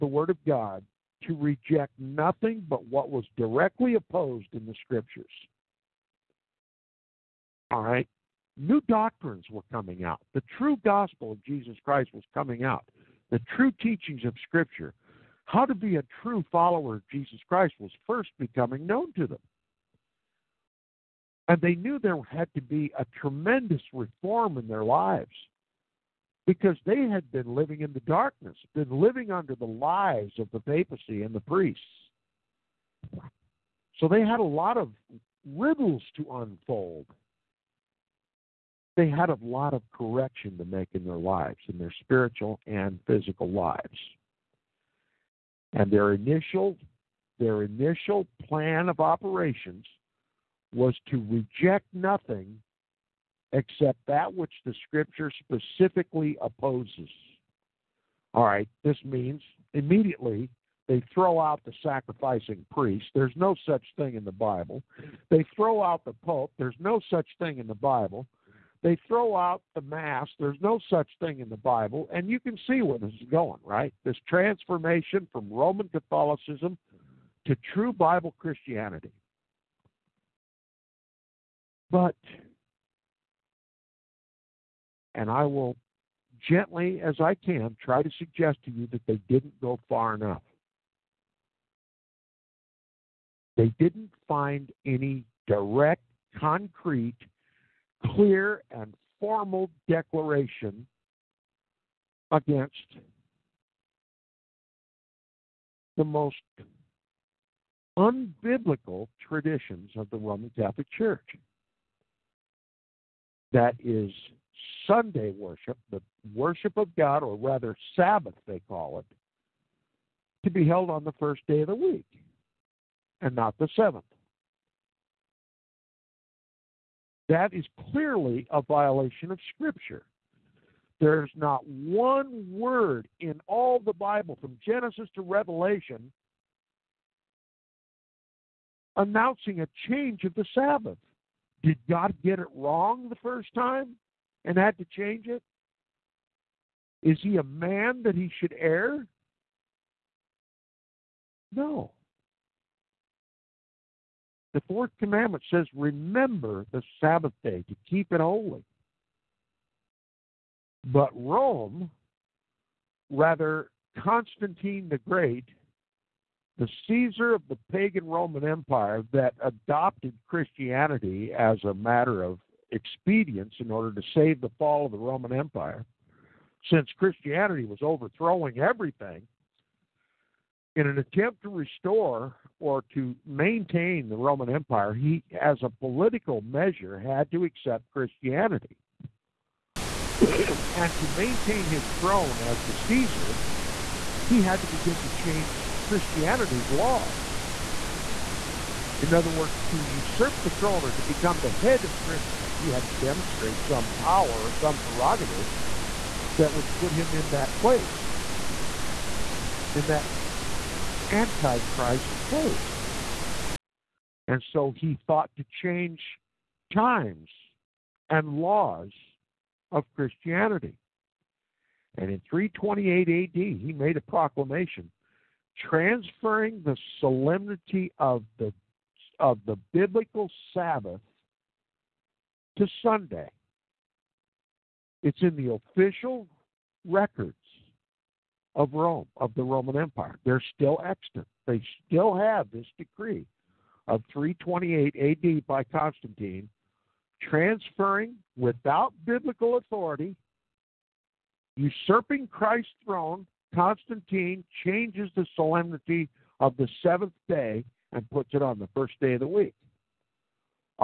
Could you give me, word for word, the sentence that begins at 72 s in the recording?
And you can see where this is going, right?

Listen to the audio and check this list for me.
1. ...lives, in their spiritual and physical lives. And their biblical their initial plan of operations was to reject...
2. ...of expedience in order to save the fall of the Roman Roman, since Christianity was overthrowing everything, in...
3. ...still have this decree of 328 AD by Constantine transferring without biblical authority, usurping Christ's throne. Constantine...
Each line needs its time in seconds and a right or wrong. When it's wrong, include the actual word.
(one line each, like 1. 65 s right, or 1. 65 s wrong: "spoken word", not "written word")
1. 41 s wrong: "initial", not "biblical"
2. 172 s wrong: "Empire", not "Roman"
3. 241 s right.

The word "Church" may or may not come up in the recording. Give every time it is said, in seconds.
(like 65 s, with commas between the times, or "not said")
110 s.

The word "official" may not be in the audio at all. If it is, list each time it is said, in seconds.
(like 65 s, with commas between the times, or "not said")
235 s.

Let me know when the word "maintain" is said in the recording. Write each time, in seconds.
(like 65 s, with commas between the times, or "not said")
183 s, 191 s.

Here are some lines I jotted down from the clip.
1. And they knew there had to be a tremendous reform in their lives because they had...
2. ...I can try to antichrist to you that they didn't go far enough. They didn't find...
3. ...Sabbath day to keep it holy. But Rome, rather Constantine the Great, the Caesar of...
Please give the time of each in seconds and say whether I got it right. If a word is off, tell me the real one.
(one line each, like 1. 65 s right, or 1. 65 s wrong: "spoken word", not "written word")
1. 21 s right
2. 87 s wrong: "suggest", not "antichrist"
3. 156 s right.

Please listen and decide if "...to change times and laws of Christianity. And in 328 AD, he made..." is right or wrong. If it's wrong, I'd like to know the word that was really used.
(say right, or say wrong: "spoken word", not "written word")
right.